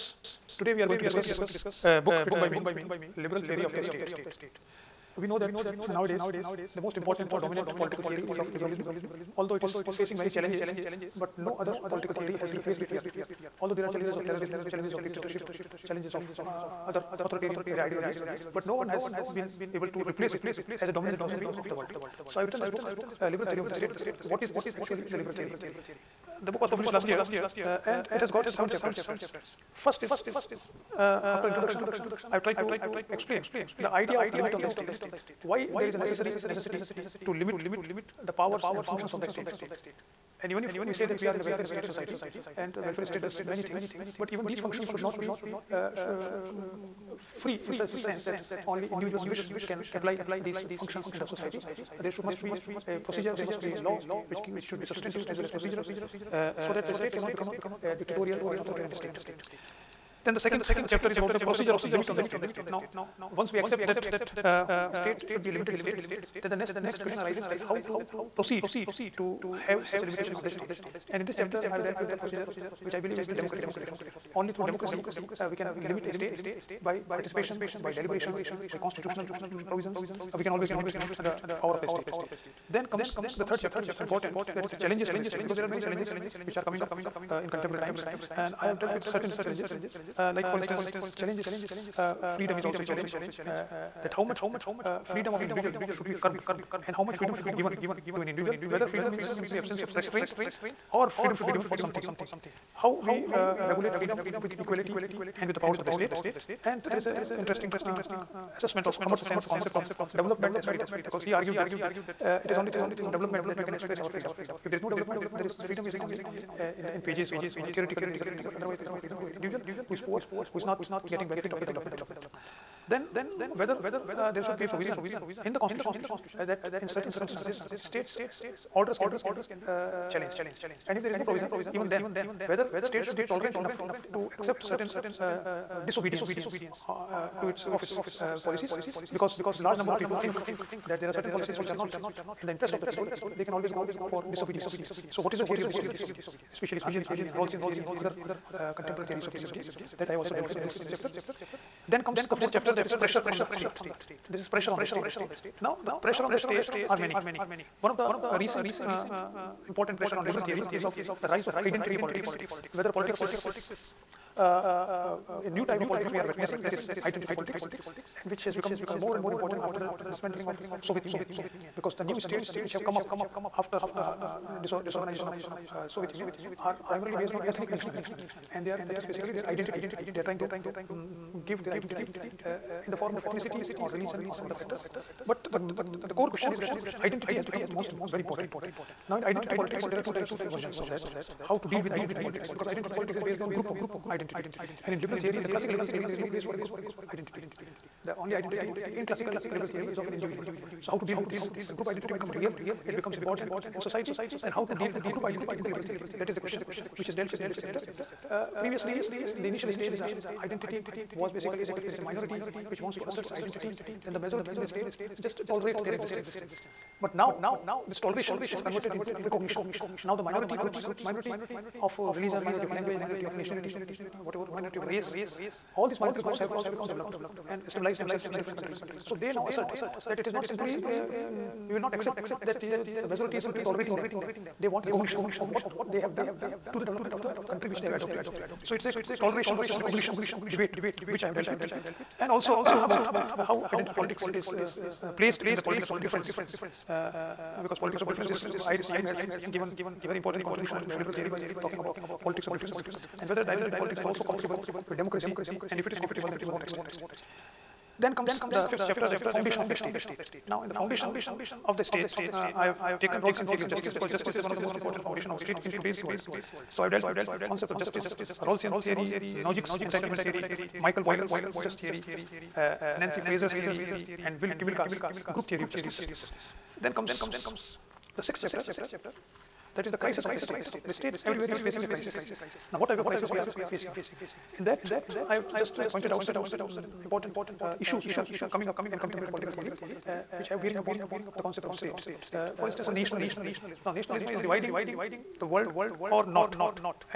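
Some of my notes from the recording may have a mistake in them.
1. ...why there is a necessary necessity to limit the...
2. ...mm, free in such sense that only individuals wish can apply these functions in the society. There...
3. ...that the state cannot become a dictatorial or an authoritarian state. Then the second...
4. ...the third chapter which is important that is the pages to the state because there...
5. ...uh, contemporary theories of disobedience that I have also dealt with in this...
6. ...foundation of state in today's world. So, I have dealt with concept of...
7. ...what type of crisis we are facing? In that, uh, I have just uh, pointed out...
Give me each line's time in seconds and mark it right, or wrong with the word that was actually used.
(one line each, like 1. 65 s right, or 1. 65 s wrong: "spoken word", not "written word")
1. 35 s right
2. 46 s right
3. 56 s right
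4. 83 s wrong: "challenges", not "pages"
5. 148 s right
6. 265 s right
7. 282 s right.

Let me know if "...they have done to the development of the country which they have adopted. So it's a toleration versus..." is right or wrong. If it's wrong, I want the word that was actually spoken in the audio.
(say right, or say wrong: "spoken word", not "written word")
right.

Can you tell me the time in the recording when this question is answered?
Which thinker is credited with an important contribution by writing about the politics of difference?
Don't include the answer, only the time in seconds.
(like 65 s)
248 s.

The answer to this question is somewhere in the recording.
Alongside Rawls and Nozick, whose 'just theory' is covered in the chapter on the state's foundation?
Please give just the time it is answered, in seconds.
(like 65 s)
270 s.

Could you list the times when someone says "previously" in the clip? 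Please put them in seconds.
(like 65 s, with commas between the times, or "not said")
208 s.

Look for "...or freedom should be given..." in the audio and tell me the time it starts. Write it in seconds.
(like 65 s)
100 s.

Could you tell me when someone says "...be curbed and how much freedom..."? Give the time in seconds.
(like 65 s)
96 s.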